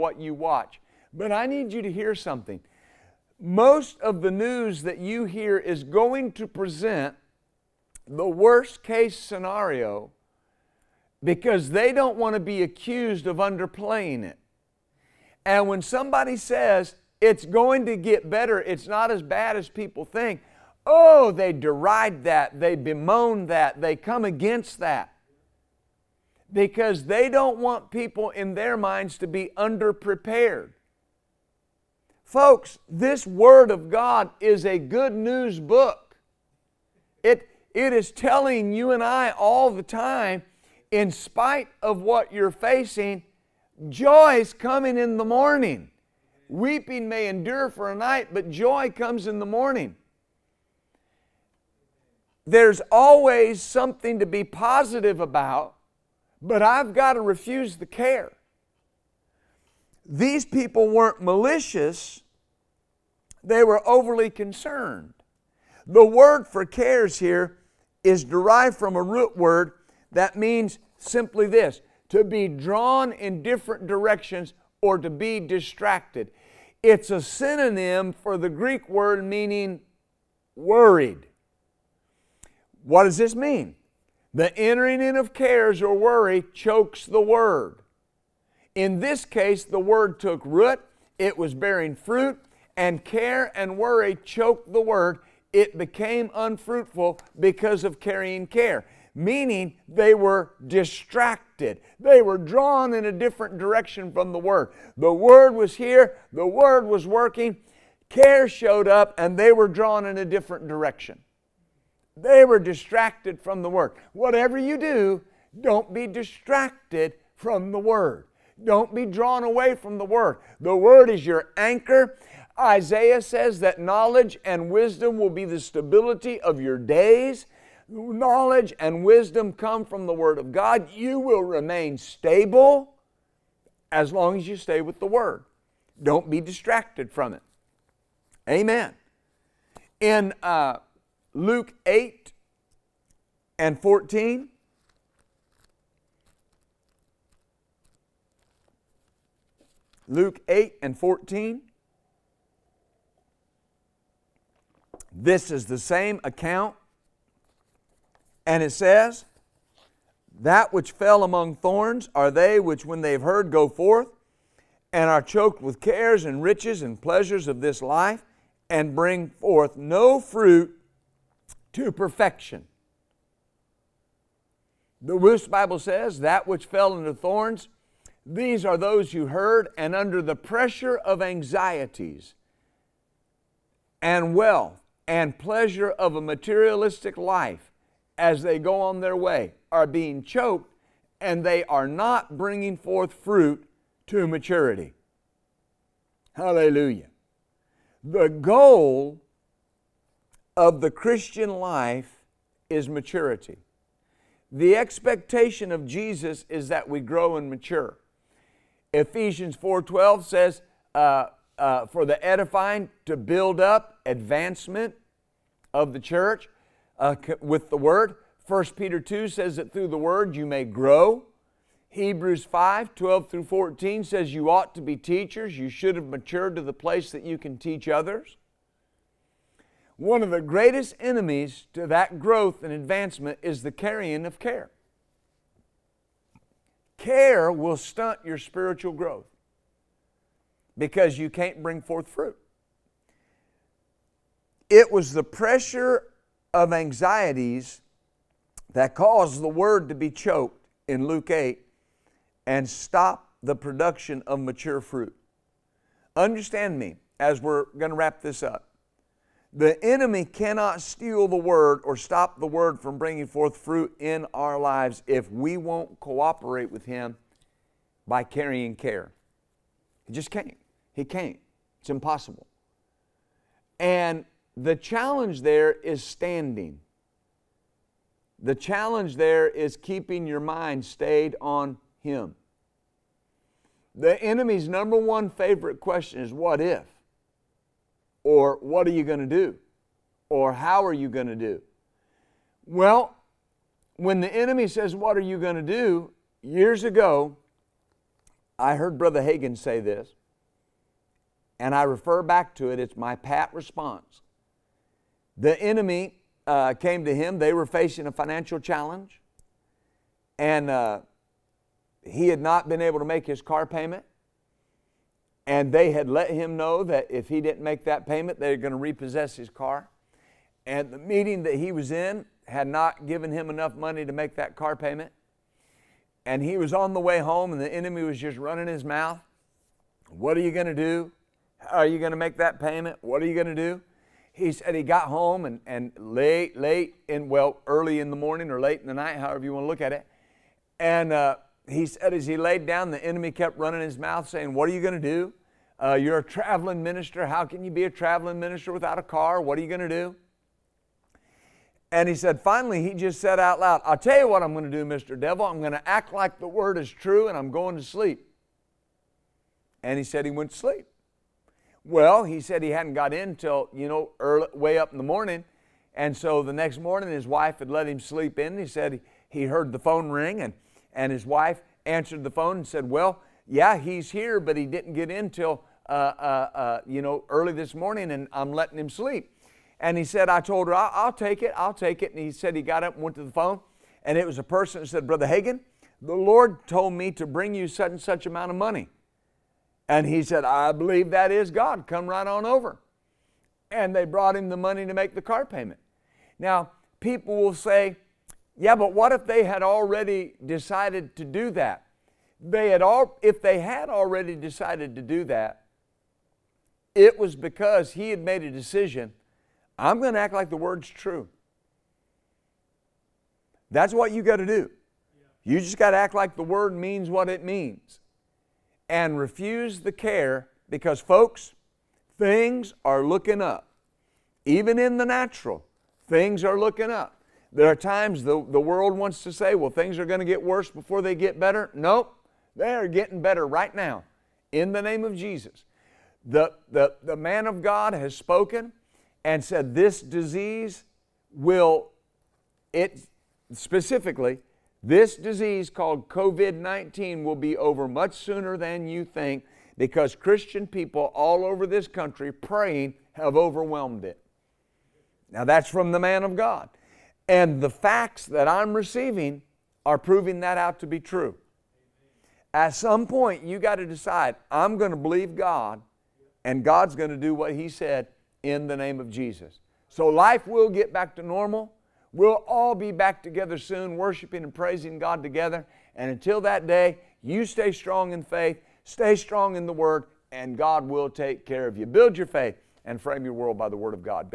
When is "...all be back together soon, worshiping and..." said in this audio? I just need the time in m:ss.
7:52.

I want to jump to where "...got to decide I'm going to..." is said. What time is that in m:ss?
7:43.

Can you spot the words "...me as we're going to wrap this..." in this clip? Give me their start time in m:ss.
4:16.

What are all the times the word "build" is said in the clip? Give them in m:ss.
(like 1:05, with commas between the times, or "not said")
3:33, 8:01.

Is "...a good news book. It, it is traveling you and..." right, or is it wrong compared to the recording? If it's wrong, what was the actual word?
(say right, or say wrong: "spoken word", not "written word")
wrong: "telling", not "traveling".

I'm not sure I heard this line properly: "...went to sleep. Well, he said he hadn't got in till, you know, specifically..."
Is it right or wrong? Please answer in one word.
wrong.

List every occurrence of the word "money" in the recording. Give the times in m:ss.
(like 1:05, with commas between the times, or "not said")
5:23, 6:28, 6:34.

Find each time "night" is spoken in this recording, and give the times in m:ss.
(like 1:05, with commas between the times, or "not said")
0:47, 5:38.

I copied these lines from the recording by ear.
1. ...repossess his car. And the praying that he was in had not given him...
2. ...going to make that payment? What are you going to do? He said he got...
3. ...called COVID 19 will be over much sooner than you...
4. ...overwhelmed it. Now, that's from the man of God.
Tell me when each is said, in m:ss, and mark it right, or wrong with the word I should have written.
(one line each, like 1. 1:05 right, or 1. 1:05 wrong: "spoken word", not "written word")
1. 5:18 wrong: "meeting", not "praying"
2. 5:31 right
3. 7:25 right
4. 7:33 right.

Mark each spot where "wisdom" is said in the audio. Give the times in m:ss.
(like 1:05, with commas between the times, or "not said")
2:04, 2:09.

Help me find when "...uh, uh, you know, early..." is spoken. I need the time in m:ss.
6:15.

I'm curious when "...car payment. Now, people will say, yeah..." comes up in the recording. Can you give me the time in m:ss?
6:35.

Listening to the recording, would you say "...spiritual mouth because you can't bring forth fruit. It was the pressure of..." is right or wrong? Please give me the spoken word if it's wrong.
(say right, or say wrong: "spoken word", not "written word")
wrong: "growth", not "mouth".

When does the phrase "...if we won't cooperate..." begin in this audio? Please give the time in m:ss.
4:25.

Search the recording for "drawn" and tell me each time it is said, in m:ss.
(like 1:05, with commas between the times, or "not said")
1:12, 1:42, 1:49, 1:59.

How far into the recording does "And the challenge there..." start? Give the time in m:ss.
4:33.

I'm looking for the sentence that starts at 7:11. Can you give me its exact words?
Nope, they are getting better right now in the name of Jesus.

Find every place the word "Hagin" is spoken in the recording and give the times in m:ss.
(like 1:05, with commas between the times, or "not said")
4:59, 6:25.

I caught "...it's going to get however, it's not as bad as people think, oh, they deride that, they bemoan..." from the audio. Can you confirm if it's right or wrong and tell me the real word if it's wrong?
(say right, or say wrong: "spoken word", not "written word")
wrong: "better", not "however".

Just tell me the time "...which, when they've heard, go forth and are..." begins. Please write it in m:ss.
2:42.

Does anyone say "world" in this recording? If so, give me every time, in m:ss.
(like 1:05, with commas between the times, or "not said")
7:08, 8:03.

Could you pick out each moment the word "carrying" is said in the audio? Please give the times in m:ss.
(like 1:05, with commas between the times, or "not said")
1:37, 3:53, 4:28.